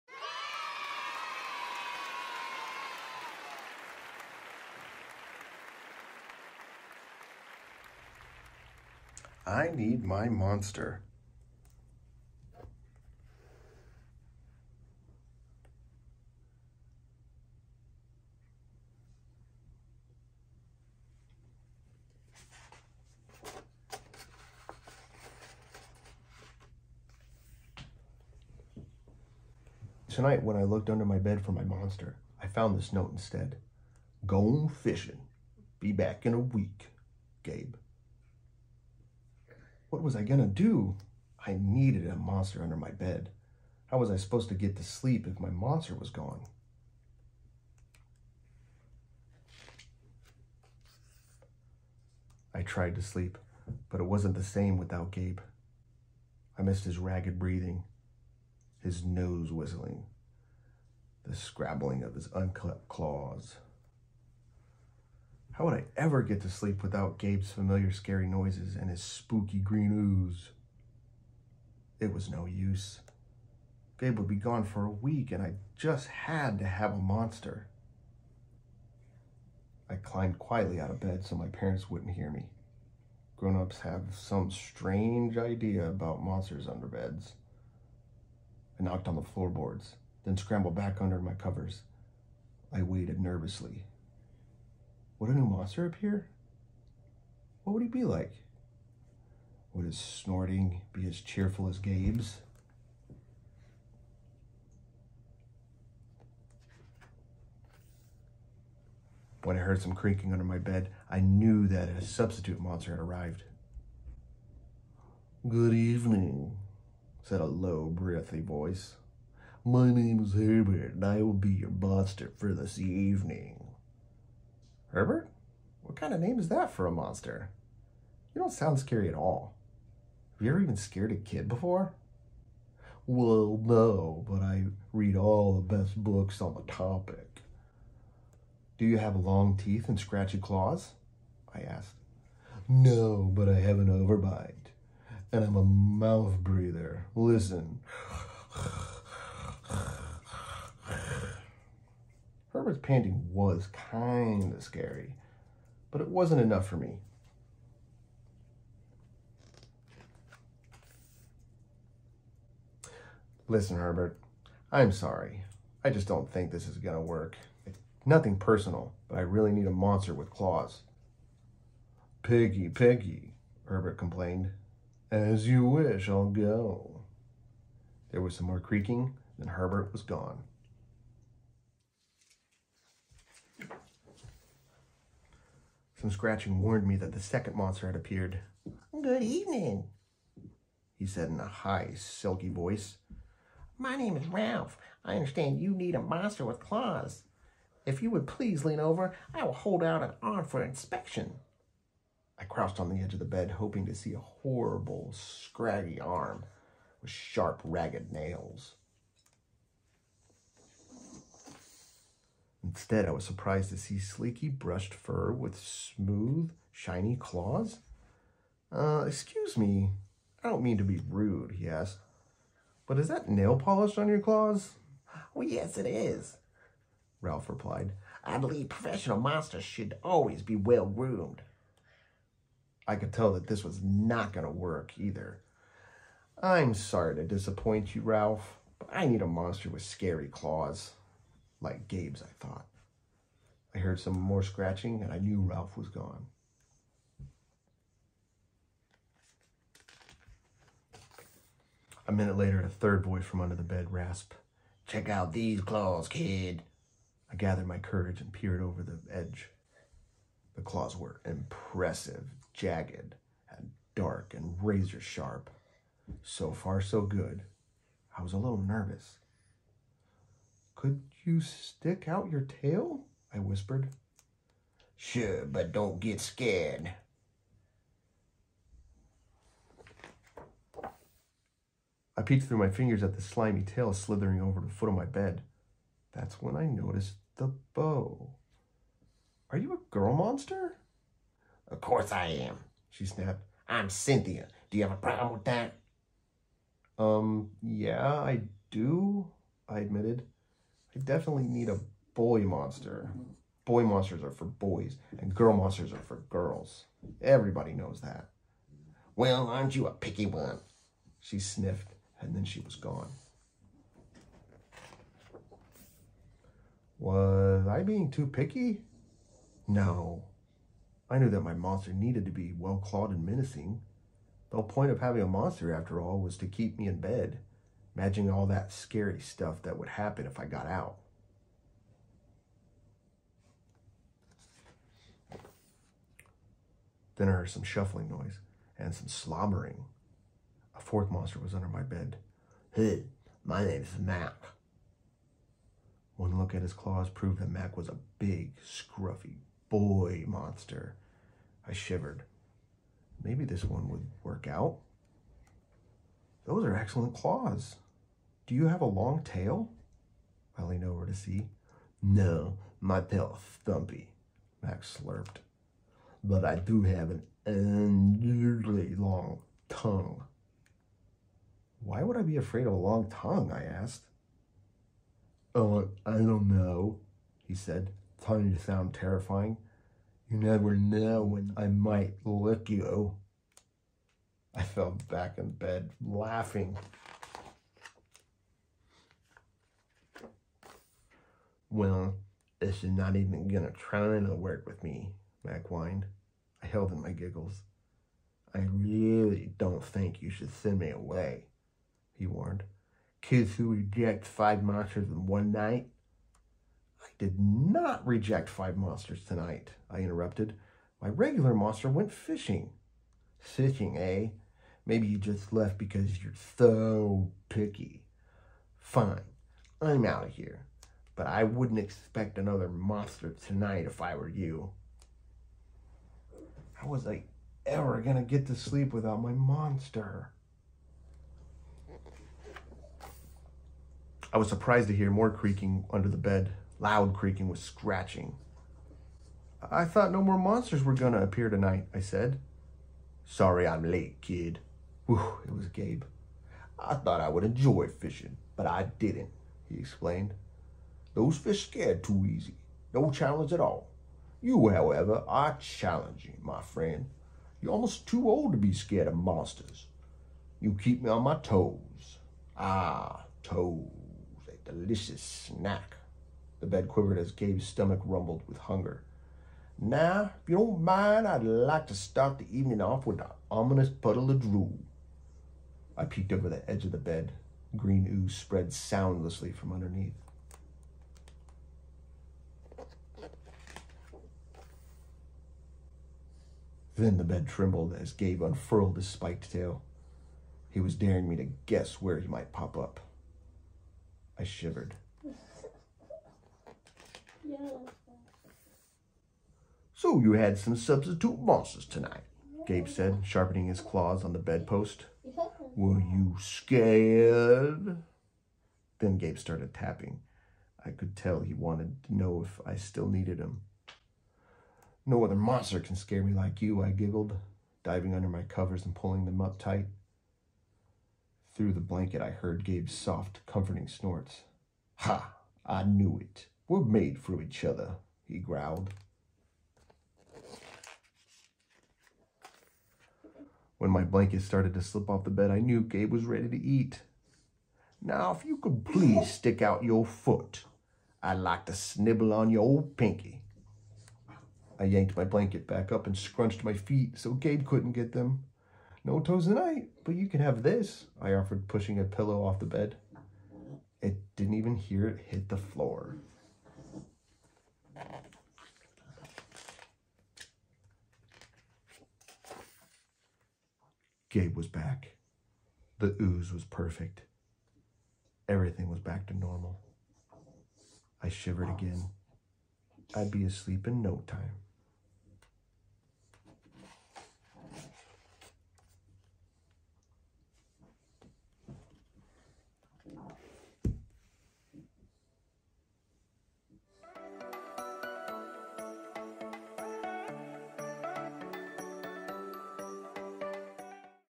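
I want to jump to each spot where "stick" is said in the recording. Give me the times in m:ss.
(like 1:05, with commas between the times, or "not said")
4:31, 8:59.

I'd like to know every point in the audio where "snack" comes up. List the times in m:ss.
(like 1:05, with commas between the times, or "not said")
7:45.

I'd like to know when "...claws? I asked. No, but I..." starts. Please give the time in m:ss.
2:20.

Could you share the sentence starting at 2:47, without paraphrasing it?
It's nothing personal, but I really need a monster with claws.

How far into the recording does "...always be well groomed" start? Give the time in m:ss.
3:50.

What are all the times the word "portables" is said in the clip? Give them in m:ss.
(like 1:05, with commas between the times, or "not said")
not said.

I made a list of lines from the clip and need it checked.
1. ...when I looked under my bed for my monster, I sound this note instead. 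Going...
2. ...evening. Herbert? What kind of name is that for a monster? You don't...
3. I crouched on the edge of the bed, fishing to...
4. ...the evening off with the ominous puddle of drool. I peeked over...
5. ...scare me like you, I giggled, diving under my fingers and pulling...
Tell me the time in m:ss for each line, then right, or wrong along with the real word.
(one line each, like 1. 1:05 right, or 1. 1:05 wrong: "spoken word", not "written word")
1. 0:30 wrong: "found", not "sound"
2. 2:02 right
3. 3:22 wrong: "hoping", not "fishing"
4. 7:52 right
5. 8:35 wrong: "covers", not "fingers".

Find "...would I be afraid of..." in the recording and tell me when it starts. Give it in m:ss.
6:12.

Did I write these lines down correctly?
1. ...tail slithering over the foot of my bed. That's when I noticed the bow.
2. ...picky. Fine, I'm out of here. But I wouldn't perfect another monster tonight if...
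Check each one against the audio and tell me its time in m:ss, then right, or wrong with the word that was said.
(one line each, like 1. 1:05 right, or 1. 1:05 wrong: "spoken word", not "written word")
1. 4:43 right
2. 6:57 wrong: "expect", not "perfect".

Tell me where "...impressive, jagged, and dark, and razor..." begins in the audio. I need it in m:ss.
4:21.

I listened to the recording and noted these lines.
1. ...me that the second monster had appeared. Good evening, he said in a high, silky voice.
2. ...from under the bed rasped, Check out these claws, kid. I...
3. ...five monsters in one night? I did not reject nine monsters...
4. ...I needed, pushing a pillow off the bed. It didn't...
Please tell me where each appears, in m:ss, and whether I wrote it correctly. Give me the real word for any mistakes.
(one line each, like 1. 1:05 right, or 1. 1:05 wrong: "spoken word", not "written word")
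1. 3:06 right
2. 4:13 right
3. 6:44 wrong: "five", not "nine"
4. 9:11 wrong: "offered", not "needed".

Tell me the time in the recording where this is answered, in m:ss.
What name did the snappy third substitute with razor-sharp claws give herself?
4:53.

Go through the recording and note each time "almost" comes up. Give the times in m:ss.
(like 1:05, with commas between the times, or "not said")
7:37.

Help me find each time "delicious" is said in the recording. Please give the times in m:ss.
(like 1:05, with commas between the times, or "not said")
7:44.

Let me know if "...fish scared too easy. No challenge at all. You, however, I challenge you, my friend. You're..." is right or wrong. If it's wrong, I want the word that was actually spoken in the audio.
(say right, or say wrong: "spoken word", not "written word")
right.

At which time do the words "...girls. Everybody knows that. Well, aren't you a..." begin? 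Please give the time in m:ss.
5:06.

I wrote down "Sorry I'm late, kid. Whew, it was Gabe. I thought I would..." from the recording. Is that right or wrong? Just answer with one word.
right.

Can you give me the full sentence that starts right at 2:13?
Well, no, but I read all the best books on the topic.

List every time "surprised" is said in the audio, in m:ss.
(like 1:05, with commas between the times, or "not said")
3:33, 7:14.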